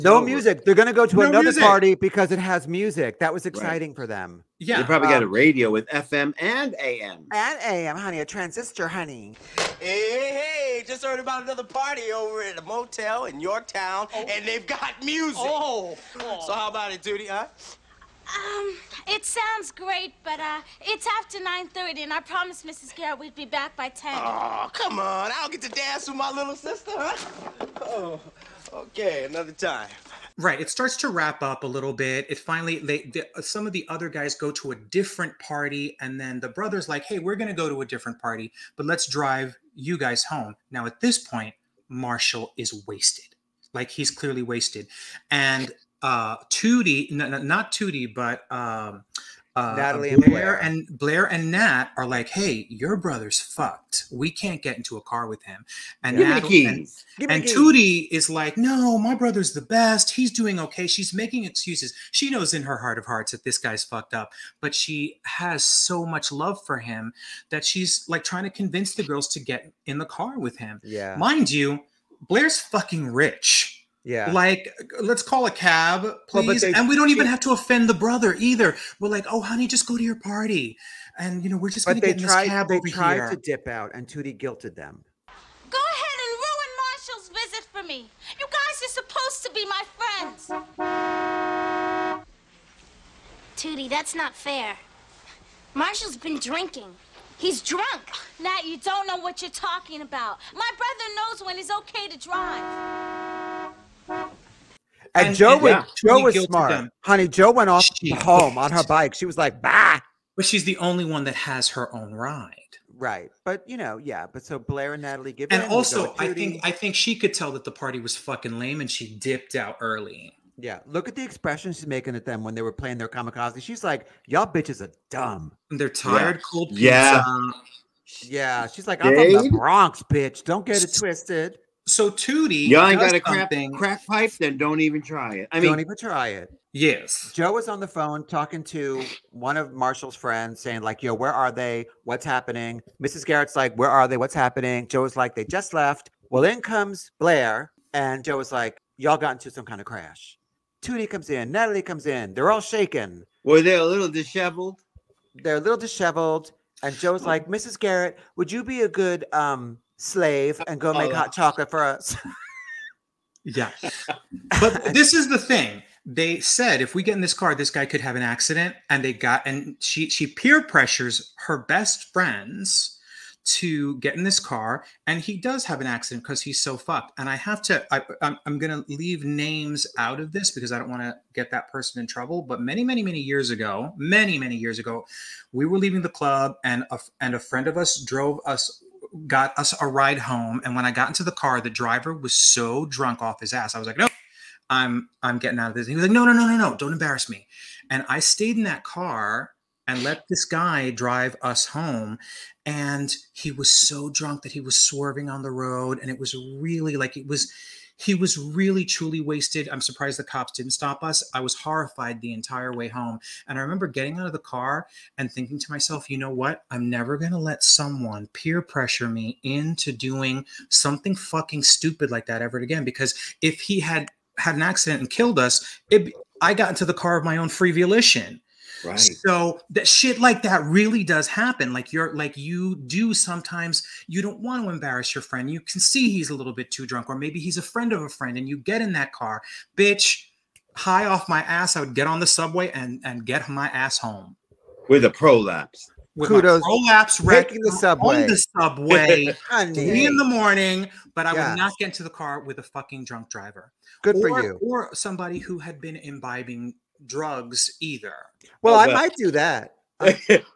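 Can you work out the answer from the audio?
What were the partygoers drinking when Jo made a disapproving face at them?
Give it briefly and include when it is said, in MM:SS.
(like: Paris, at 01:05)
kamikaze, at 02:03.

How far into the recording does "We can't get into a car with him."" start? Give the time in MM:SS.
00:54.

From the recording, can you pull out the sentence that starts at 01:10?
Yeah, mind you, Blair's fucking rich.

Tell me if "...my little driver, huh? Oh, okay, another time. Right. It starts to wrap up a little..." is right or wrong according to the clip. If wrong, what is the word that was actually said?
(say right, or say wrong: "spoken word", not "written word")
wrong: "sister", not "driver".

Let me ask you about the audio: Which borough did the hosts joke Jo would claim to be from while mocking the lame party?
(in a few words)
the Bronx.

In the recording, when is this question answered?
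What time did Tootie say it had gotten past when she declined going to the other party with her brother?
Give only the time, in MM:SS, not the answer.
00:21.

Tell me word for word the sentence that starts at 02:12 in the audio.
Y'all ain't got a crap, crack pipe, then don't even try it.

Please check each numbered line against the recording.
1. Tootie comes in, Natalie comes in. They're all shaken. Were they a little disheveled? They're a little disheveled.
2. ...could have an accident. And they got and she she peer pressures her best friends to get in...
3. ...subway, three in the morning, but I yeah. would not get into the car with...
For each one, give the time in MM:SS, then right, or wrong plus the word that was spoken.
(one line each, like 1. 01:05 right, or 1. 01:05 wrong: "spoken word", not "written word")
1. 02:30 right
2. 02:47 right
3. 04:08 right.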